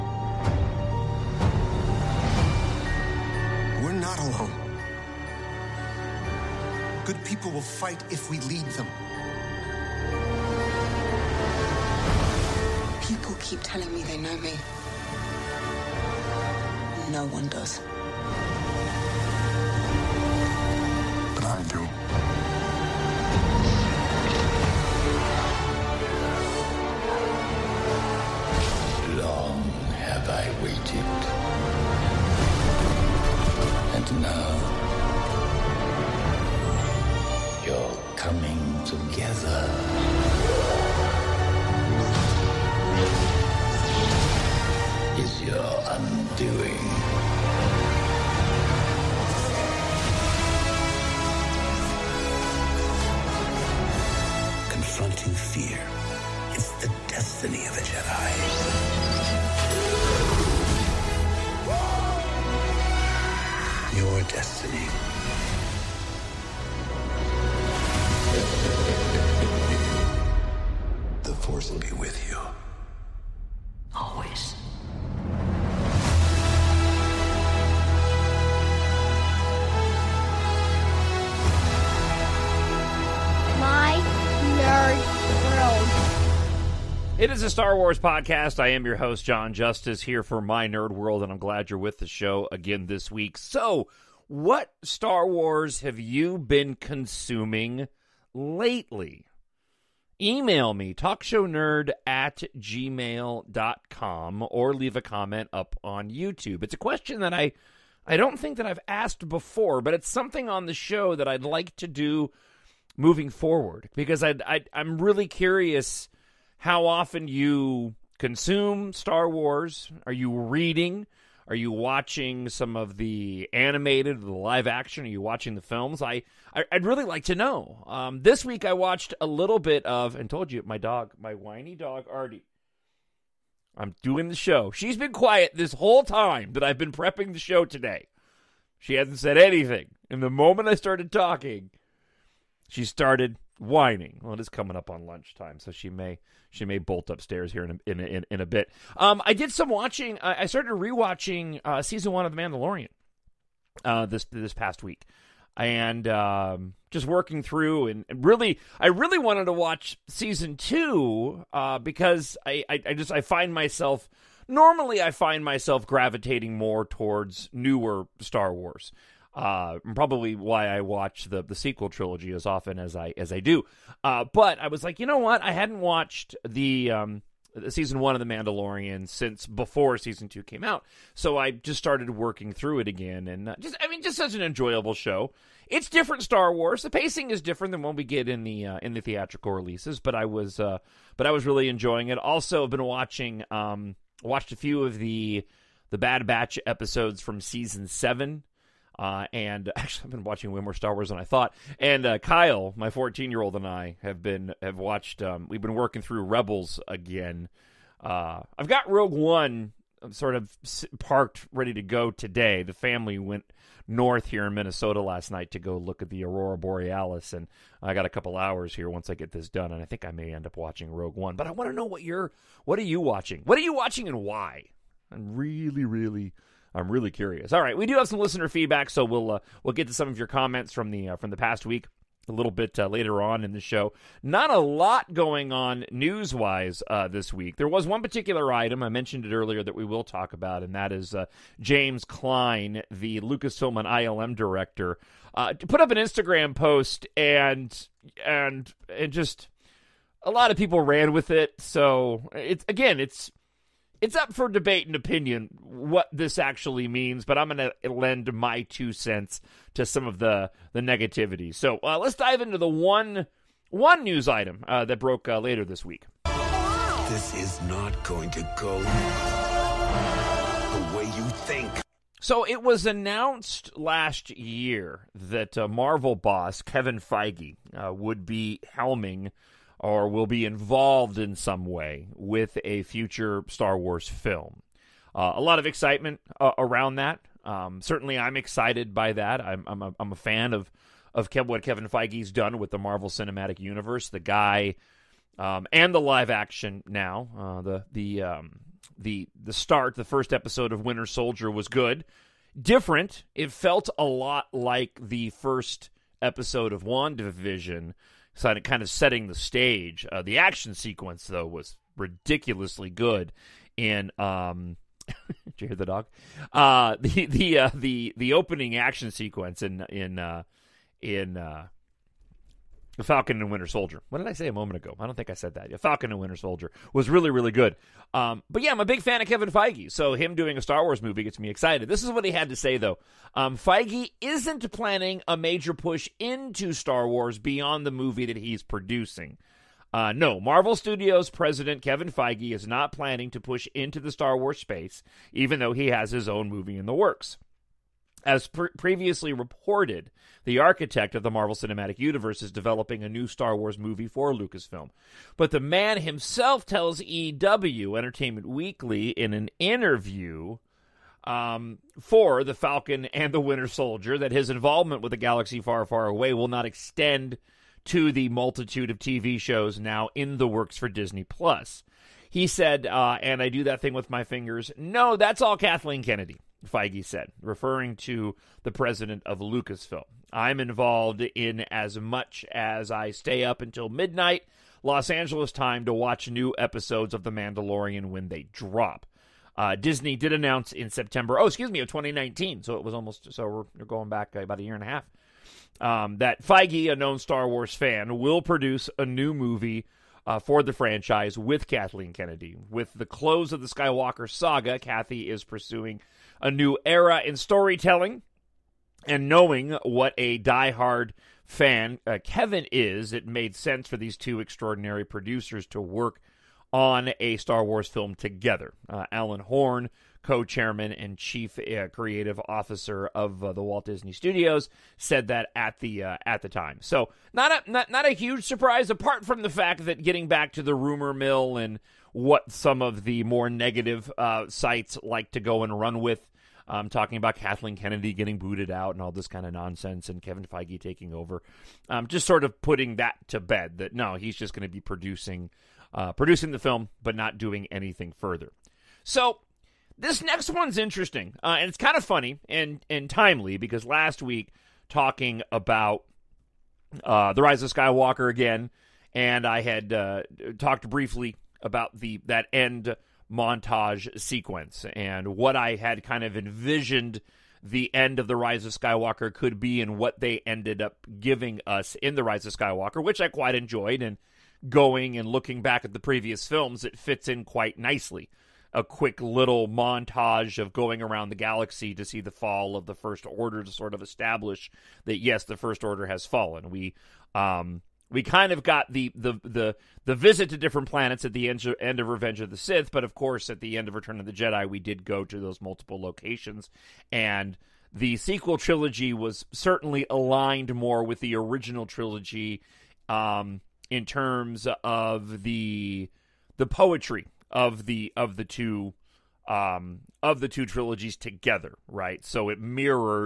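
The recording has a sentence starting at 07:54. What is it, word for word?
And going and looking back at the previous films, it fits in quite nicely.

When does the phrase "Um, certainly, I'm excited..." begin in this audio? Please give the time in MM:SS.
04:47.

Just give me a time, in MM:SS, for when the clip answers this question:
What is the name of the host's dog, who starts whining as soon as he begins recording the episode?
02:12.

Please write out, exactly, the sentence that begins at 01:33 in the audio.
So, what Star Wars have you been consuming lately?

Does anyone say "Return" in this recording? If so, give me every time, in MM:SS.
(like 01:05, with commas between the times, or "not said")
08:13.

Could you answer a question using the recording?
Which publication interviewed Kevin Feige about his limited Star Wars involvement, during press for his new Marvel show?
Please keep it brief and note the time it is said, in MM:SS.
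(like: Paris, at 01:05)
Entertainment Weekly, at 05:57.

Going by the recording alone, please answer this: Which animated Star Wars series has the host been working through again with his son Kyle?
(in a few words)
Rebels.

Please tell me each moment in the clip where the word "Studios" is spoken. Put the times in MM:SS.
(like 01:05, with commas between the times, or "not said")
05:40, 07:04.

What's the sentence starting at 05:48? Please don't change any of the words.
As pre- previously reported, the architect of the Marvel Cinematic Universe is developing a new Star Wars movie for Lucasfilm.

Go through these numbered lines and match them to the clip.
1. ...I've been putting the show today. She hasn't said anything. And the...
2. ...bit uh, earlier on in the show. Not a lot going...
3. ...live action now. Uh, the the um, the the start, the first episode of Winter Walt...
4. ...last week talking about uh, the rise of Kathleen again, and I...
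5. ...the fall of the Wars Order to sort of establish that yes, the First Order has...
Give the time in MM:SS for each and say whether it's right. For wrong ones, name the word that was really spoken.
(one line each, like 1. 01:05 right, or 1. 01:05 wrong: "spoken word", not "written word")
1. 02:16 wrong: "prepping", not "putting"
2. 03:52 wrong: "later", not "earlier"
3. 04:56 wrong: "Soldier", not "Walt"
4. 07:33 wrong: "Skywalker", not "Kathleen"
5. 08:02 wrong: "First", not "Wars".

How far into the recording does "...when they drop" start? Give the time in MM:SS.
06:28.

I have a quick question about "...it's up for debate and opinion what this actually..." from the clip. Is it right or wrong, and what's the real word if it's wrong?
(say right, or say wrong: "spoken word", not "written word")
right.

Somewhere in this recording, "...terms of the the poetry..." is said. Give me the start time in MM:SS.
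08:24.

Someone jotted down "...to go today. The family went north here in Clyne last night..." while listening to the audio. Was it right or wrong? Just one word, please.
wrong.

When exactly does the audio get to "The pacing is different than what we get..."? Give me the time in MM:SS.
03:06.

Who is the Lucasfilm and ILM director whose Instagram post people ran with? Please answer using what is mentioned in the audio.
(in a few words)
James Clyne.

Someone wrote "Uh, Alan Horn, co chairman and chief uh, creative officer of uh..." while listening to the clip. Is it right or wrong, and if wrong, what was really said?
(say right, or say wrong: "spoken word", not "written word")
right.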